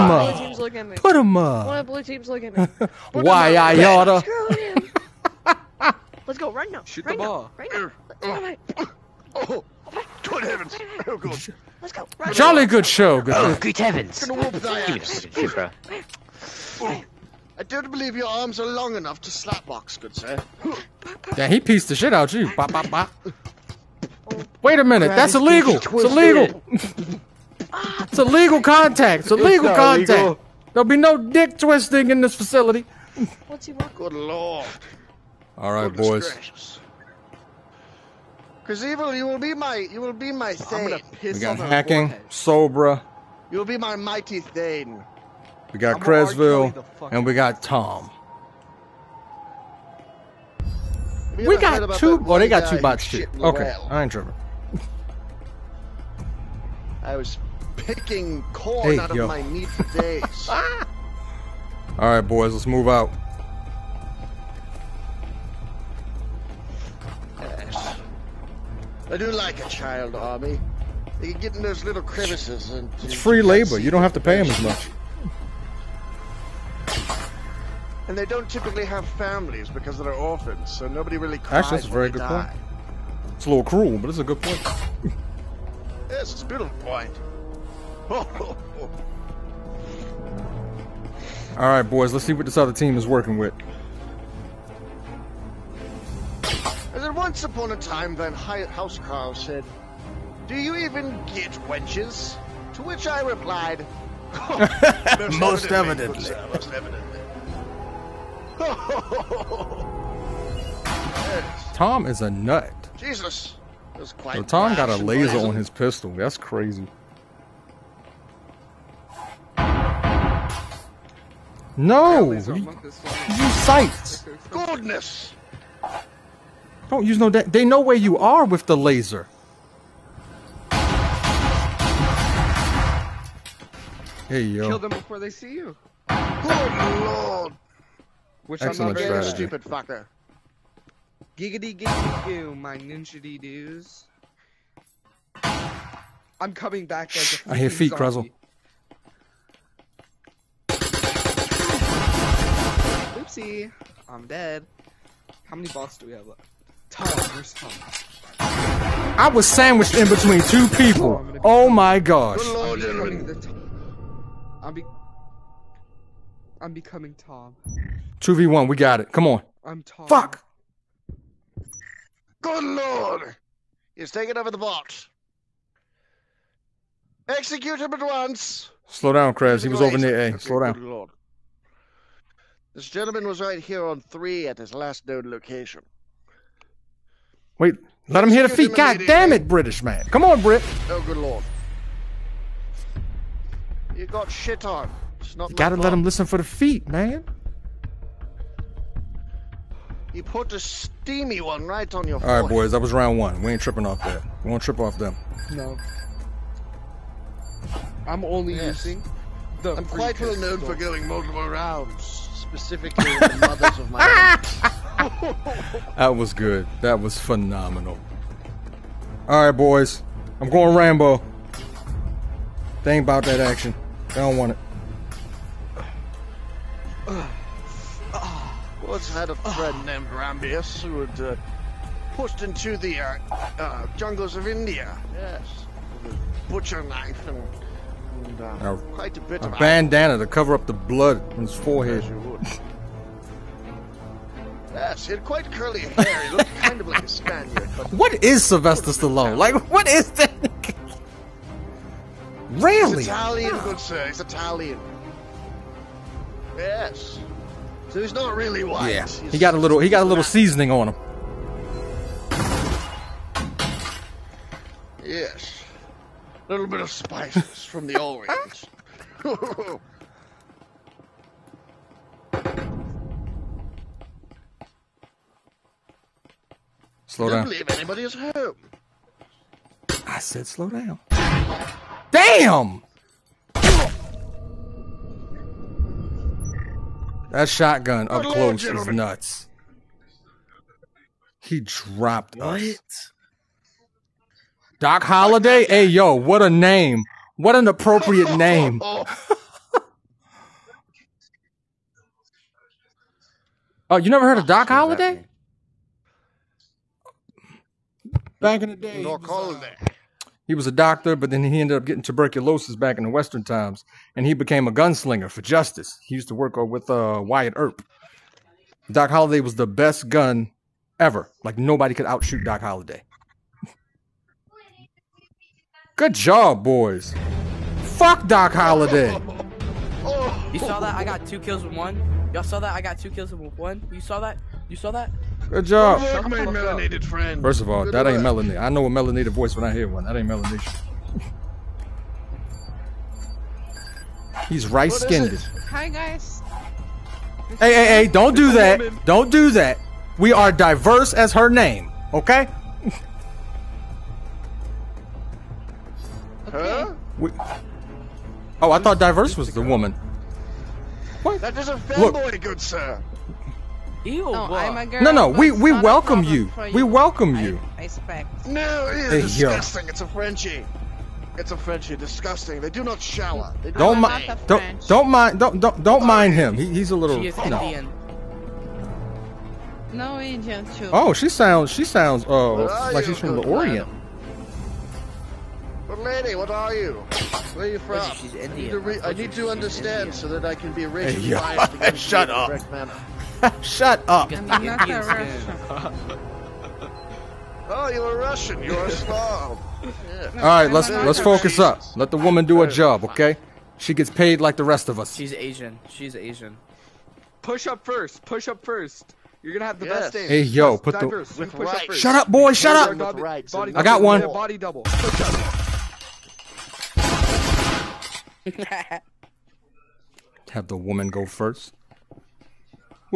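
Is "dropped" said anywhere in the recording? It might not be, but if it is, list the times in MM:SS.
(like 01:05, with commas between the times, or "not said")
04:51.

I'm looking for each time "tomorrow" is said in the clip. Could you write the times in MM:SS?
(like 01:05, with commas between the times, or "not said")
not said.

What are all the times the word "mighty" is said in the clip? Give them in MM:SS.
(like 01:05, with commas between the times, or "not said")
00:43.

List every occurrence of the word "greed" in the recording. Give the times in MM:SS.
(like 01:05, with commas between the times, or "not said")
not said.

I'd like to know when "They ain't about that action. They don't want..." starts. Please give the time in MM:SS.
03:42.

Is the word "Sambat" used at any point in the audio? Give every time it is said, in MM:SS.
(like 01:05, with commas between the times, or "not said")
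not said.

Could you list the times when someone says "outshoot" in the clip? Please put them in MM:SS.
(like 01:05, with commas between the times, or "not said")
05:22.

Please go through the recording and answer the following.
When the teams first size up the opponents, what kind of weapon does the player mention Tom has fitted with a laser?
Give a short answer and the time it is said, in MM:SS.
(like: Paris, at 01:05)
pistol, at 01:55.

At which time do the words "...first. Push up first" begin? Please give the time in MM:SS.
06:47.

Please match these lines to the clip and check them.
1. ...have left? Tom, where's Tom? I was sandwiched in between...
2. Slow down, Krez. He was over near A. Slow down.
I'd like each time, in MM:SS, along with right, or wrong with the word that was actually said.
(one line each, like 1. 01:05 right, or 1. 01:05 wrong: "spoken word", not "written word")
1. 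02:36 right
2. 02:58 right.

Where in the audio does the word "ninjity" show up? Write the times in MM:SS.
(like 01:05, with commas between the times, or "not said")
02:22.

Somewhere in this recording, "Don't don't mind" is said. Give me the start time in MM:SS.
06:14.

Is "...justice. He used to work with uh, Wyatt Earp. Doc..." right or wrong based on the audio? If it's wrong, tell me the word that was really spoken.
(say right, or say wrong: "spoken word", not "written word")
right.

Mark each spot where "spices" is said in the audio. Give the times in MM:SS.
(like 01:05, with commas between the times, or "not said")
04:26.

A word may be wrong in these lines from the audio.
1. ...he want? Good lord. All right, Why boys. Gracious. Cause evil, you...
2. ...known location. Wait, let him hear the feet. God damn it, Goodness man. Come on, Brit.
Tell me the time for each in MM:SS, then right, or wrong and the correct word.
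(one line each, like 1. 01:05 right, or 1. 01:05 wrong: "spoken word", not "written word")
1. 00:33 wrong: "Goodness", not "Why"
2. 03:05 wrong: "British", not "Goodness".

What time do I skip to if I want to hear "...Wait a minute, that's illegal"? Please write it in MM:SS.
00:24.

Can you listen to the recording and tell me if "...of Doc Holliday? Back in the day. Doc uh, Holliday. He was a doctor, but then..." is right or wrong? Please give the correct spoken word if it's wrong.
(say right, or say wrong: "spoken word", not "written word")
right.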